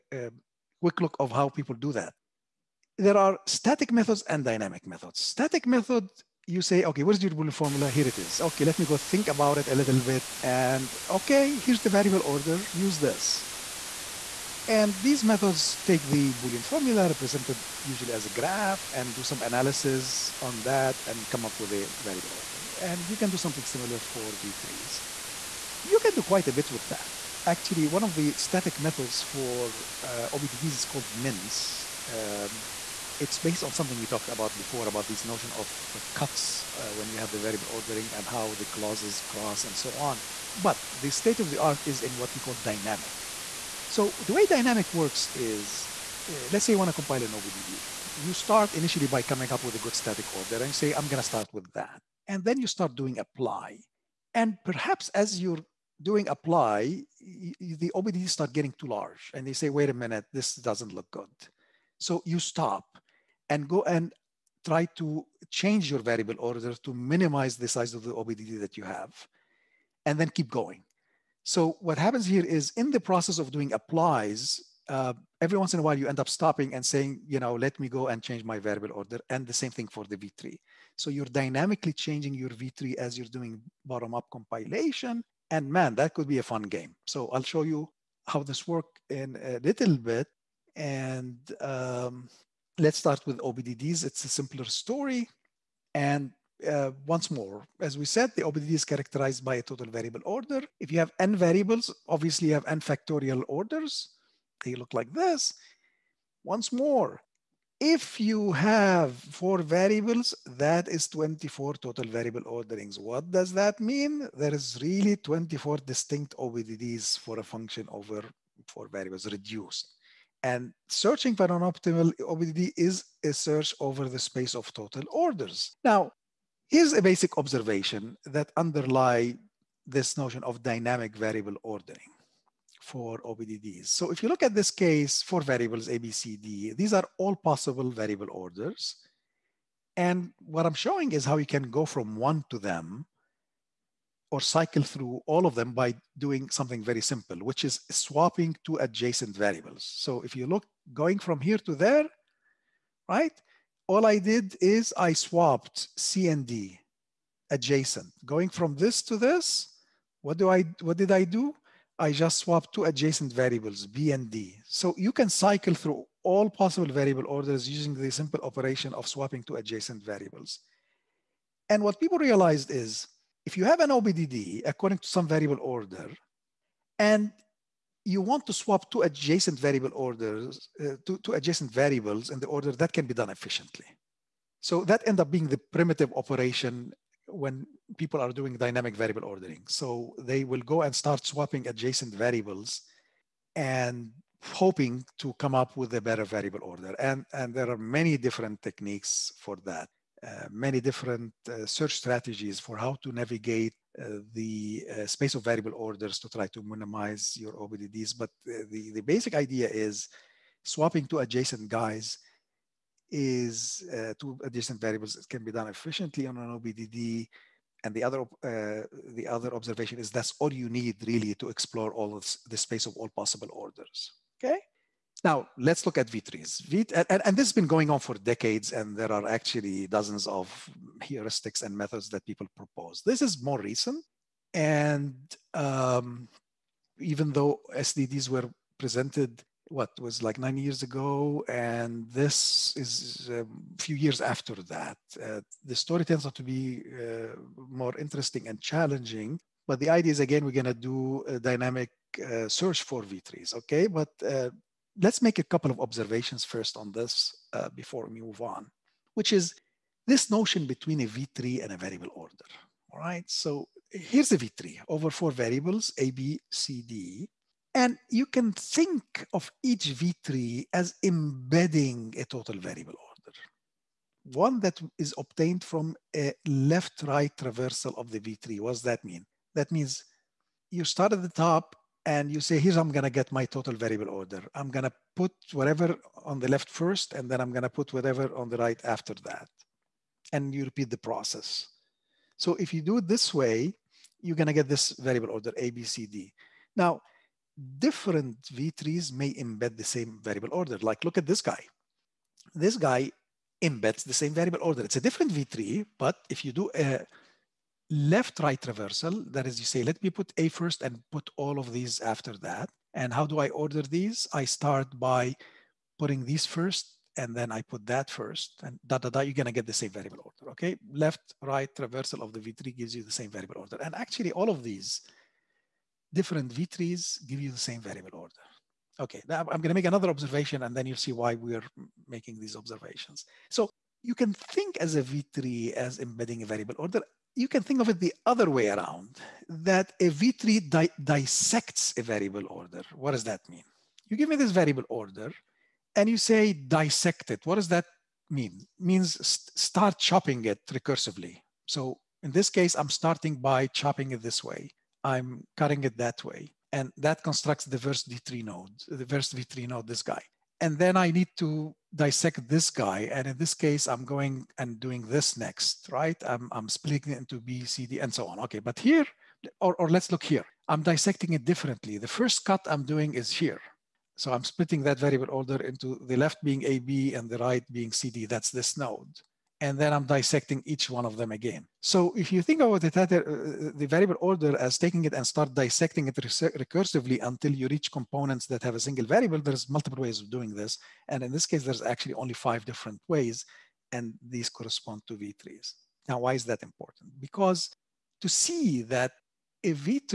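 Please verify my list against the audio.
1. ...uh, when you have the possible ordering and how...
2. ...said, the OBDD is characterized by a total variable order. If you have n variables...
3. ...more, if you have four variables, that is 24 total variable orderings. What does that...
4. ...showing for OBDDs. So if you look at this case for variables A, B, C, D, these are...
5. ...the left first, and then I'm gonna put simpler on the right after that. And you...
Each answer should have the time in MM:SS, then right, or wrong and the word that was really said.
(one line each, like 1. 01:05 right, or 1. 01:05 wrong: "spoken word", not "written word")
1. 00:36 wrong: "variable", not "possible"
2. 01:38 right
3. 01:46 right
4. 02:11 wrong: "ordering", not "showing"
5. 04:46 wrong: "whatever", not "simpler".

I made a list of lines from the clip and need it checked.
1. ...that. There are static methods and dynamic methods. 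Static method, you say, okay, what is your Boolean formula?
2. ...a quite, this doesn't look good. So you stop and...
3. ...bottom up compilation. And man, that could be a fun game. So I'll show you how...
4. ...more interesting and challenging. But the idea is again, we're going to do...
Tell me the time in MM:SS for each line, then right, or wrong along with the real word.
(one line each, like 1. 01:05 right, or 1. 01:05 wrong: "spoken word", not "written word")
1. 00:01 right
2. 00:59 wrong: "minute", not "quite"
3. 01:23 right
4. 04:07 right.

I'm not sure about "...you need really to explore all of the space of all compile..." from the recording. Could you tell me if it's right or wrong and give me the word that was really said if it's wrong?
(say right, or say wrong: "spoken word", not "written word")
wrong: "possible", not "compile".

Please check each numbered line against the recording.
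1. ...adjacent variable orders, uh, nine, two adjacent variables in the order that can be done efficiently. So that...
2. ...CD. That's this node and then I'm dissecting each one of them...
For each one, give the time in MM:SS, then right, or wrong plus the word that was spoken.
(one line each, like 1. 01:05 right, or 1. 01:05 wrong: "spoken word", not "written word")
1. 02:59 wrong: "two", not "nine"
2. 06:17 right.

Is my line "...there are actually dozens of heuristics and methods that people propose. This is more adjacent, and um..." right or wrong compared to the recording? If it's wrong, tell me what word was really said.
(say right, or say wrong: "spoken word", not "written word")
wrong: "recent", not "adjacent".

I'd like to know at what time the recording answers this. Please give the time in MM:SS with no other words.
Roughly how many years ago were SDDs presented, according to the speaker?
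04:00.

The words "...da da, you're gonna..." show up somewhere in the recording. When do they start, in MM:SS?
05:18.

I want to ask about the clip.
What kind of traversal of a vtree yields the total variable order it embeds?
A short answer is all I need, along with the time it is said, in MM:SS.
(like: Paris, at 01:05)
Left-right traversal, at 04:36.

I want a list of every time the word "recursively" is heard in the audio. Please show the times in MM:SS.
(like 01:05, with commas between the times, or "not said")
05:50, 06:26.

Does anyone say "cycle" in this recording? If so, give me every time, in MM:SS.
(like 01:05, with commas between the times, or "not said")
02:24, 02:45.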